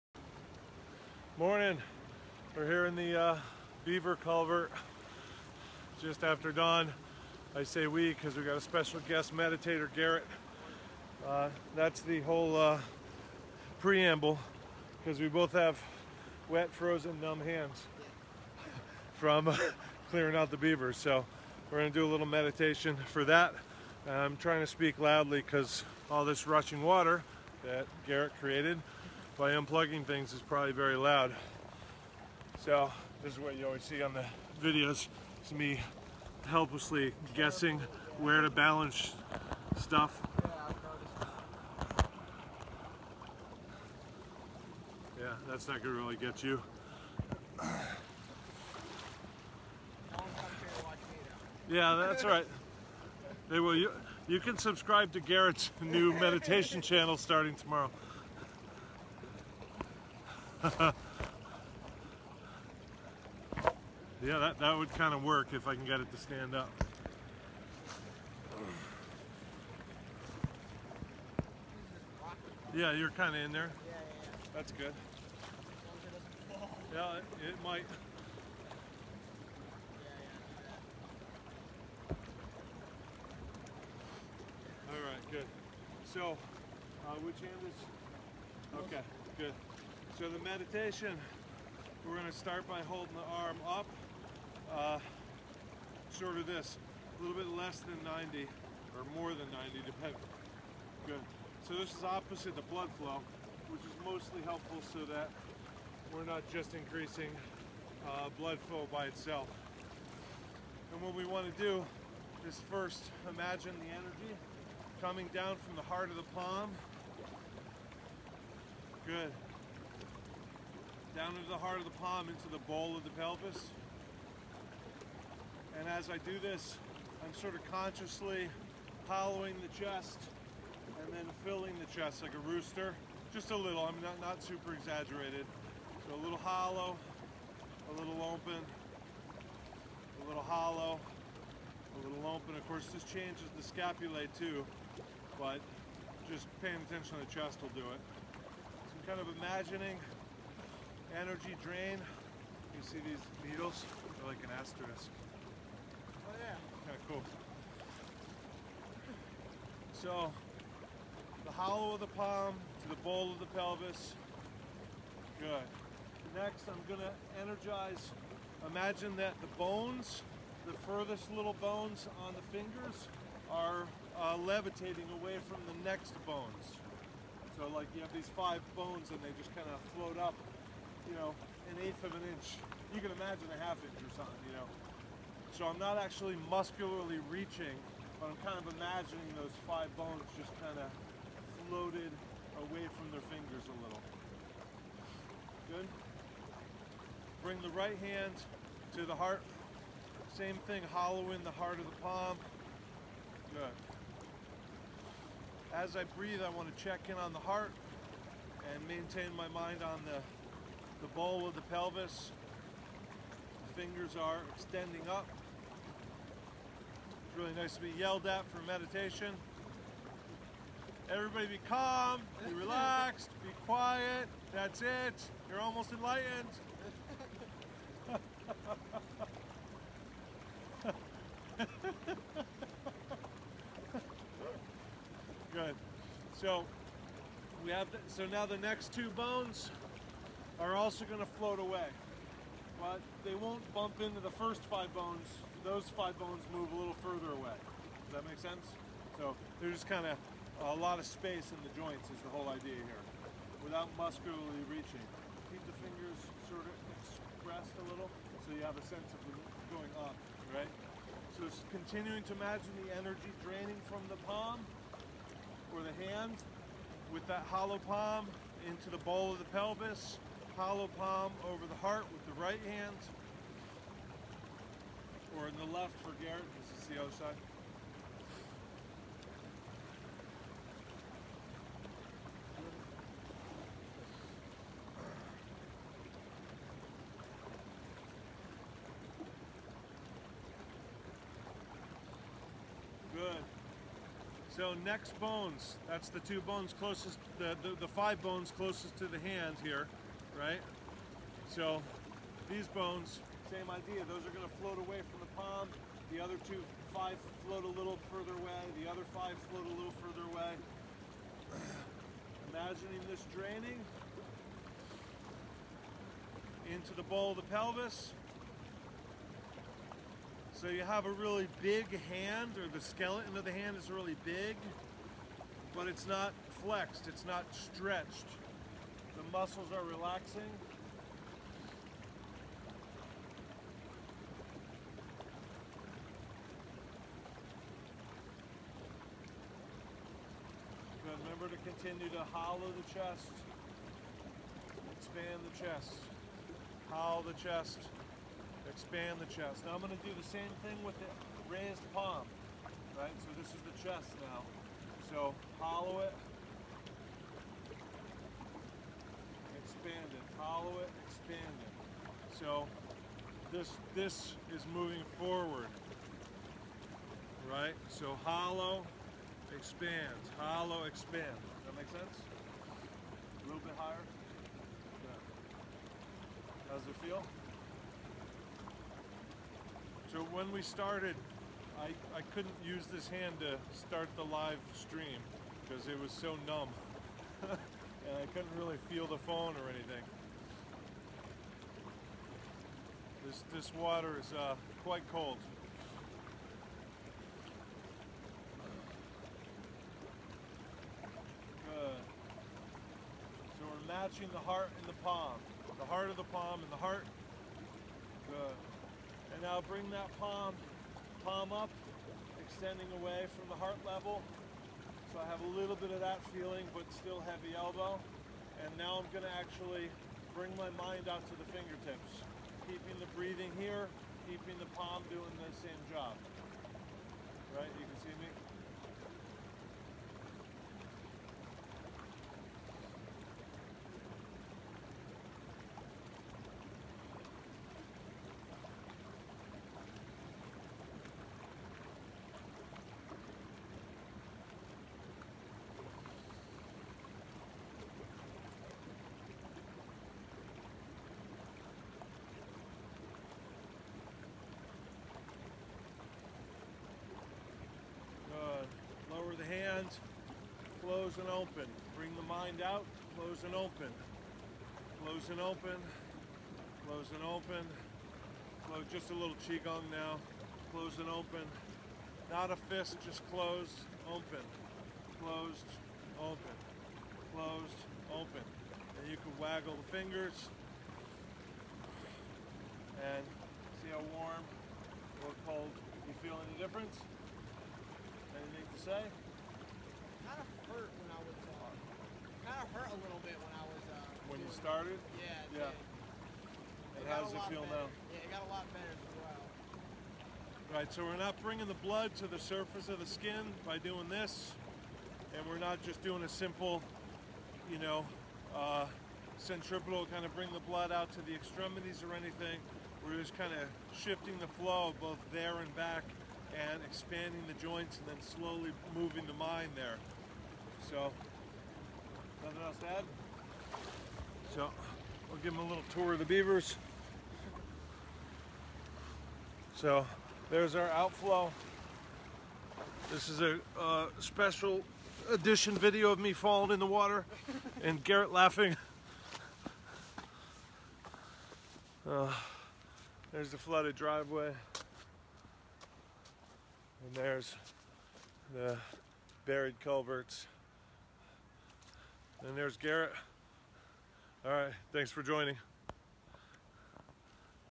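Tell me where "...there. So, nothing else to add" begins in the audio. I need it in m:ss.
8:39.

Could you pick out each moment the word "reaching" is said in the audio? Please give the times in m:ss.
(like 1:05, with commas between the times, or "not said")
3:07, 4:14.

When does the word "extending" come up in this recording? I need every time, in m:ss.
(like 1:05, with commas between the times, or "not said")
3:34, 6:52.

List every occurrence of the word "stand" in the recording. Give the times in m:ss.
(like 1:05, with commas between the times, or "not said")
1:06.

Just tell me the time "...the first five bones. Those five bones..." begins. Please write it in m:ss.
4:04.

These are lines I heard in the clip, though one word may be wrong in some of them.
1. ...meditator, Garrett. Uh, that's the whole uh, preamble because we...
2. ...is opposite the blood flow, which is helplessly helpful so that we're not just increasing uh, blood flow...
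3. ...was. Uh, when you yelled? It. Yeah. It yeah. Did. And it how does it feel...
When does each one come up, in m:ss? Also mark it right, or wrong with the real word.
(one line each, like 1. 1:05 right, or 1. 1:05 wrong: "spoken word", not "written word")
1. 0:09 right
2. 1:41 wrong: "mostly", not "helplessly"
3. 8:13 wrong: "started", not "yelled".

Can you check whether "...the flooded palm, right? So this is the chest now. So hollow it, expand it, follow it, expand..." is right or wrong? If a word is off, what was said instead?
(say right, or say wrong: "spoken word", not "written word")
wrong: "raised", not "flooded".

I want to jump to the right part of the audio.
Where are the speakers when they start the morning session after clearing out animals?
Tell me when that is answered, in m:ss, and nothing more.
0:03.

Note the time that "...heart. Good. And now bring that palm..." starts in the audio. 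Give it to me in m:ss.
6:46.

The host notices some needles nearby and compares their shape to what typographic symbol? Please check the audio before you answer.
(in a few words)
asterisk.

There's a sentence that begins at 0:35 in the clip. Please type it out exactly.
It's me helplessly guessing where to balance stuff.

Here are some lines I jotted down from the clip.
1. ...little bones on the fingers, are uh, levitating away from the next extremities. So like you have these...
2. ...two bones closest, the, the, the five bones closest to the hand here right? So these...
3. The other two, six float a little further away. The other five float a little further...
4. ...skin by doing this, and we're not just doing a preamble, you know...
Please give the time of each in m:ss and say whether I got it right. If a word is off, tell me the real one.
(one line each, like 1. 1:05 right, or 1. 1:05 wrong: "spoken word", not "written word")
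1. 2:51 wrong: "bones", not "extremities"
2. 4:56 right
3. 5:06 wrong: "five", not "six"
4. 8:23 wrong: "simple", not "preamble".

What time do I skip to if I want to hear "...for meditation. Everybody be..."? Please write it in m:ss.
3:38.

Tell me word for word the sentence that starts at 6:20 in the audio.
So when we started, I, I couldn't use this hand to start the live stream because it was so numb.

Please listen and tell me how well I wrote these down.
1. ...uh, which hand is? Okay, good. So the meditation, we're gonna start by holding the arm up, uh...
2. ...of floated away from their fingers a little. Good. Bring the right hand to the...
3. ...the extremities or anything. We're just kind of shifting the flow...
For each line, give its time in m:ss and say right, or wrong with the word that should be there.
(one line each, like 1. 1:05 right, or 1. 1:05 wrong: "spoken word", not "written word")
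1. 1:27 right
2. 3:10 right
3. 8:31 right.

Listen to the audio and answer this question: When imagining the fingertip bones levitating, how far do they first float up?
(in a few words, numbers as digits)
1/8 inch.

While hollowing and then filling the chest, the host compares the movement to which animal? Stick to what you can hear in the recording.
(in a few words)
rooster.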